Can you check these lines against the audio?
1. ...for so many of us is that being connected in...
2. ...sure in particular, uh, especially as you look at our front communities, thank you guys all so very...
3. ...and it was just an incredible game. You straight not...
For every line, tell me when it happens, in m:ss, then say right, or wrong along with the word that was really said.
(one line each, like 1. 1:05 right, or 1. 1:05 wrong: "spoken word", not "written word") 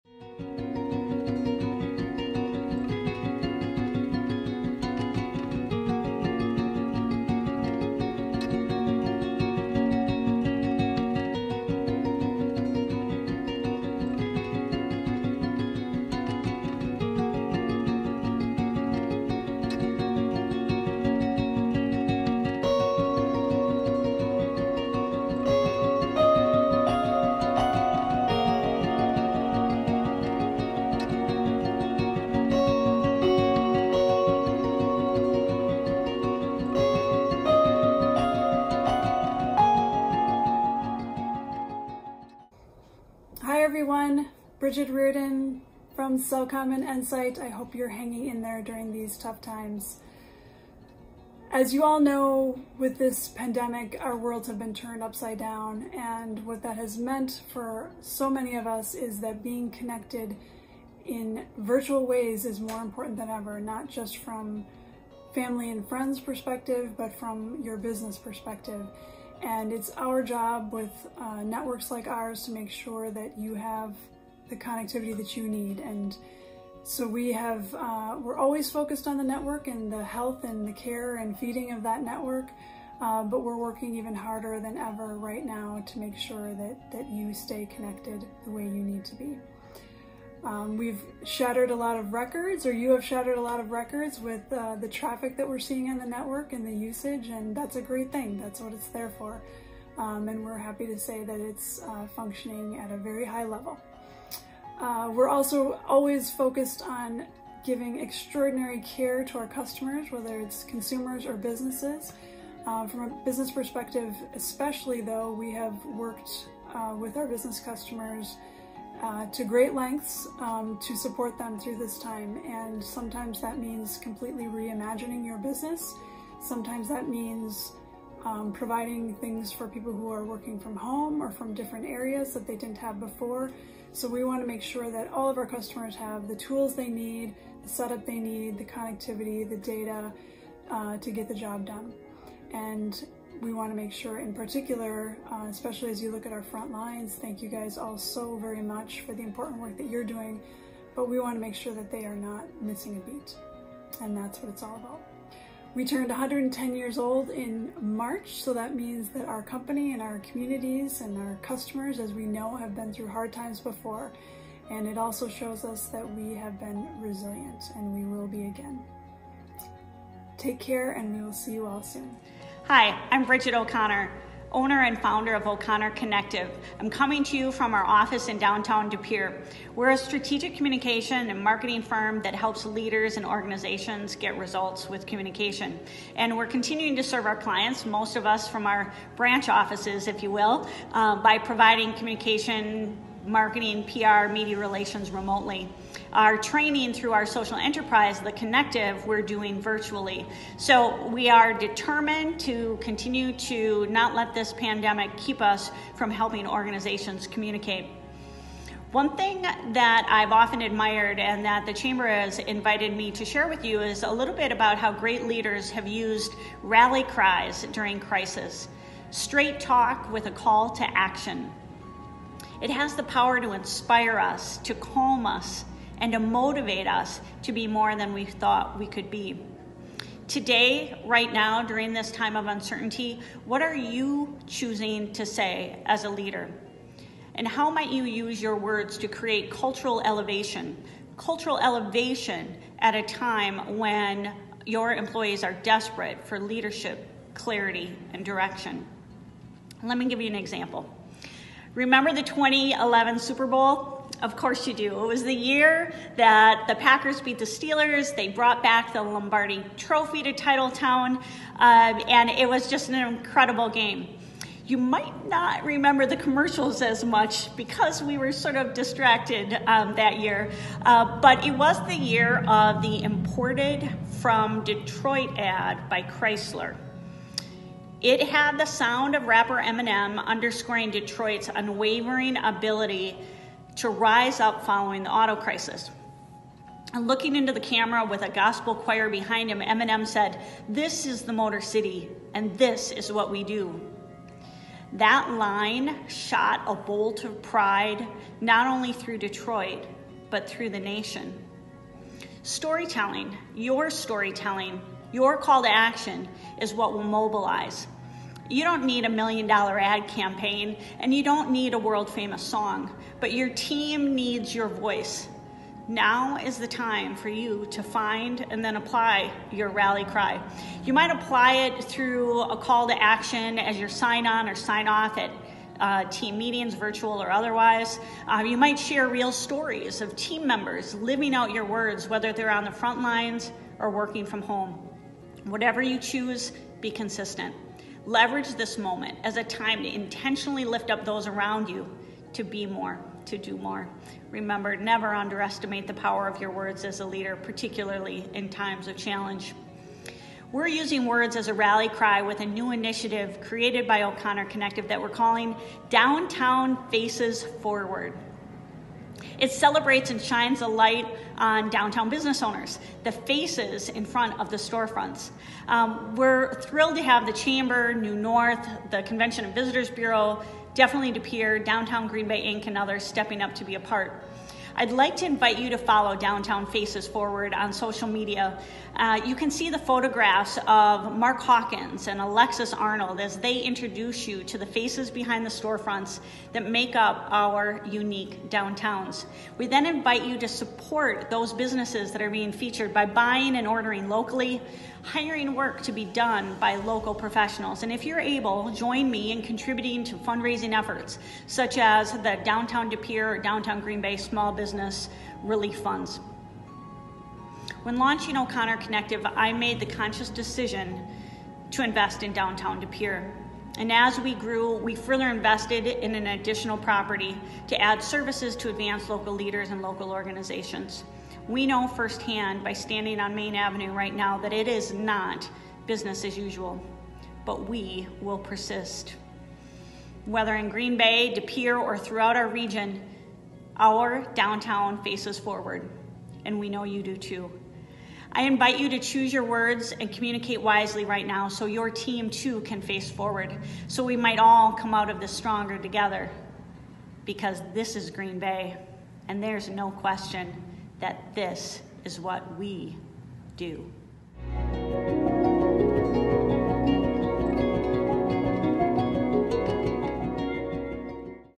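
1. 0:57 right
2. 2:23 wrong: "lines", not "communities"
3. 4:21 wrong: "might", not "straight".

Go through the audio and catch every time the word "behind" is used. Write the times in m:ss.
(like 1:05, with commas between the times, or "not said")
4:49, 6:25.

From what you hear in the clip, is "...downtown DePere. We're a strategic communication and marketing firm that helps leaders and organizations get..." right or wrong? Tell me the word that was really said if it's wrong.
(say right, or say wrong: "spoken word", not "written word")
right.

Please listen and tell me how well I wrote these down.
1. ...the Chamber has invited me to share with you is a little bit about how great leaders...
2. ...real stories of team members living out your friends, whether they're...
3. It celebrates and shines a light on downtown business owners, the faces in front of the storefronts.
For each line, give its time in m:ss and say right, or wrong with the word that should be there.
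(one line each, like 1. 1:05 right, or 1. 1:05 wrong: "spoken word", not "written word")
1. 3:31 right
2. 5:29 wrong: "words", not "friends"
3. 5:59 right.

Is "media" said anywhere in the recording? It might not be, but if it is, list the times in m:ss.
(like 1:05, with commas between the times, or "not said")
3:14, 6:18.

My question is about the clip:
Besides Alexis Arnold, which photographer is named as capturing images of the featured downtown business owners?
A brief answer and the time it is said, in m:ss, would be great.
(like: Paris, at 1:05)
Mark Hawkins, at 6:21.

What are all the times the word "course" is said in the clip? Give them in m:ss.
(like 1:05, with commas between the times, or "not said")
4:14.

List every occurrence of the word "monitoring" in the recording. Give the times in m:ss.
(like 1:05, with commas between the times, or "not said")
not said.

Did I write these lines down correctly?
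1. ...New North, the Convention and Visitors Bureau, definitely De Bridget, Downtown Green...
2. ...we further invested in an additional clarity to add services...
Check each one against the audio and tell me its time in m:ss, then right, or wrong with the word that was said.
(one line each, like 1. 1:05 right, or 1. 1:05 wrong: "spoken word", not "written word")
1. 6:07 wrong: "Pere", not "Bridget"
2. 6:54 wrong: "property", not "clarity".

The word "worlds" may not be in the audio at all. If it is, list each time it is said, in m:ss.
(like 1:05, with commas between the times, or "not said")
0:54, 5:11.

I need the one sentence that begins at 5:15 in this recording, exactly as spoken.
Now is the time for you to find and then apply your rally cry.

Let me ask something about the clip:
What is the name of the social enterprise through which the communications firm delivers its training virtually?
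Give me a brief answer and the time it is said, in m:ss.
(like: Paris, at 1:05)
The Connective, at 3:18.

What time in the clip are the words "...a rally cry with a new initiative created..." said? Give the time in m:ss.
5:51.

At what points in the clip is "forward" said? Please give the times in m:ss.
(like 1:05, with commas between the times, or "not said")
5:57, 6:17, 7:15, 7:23.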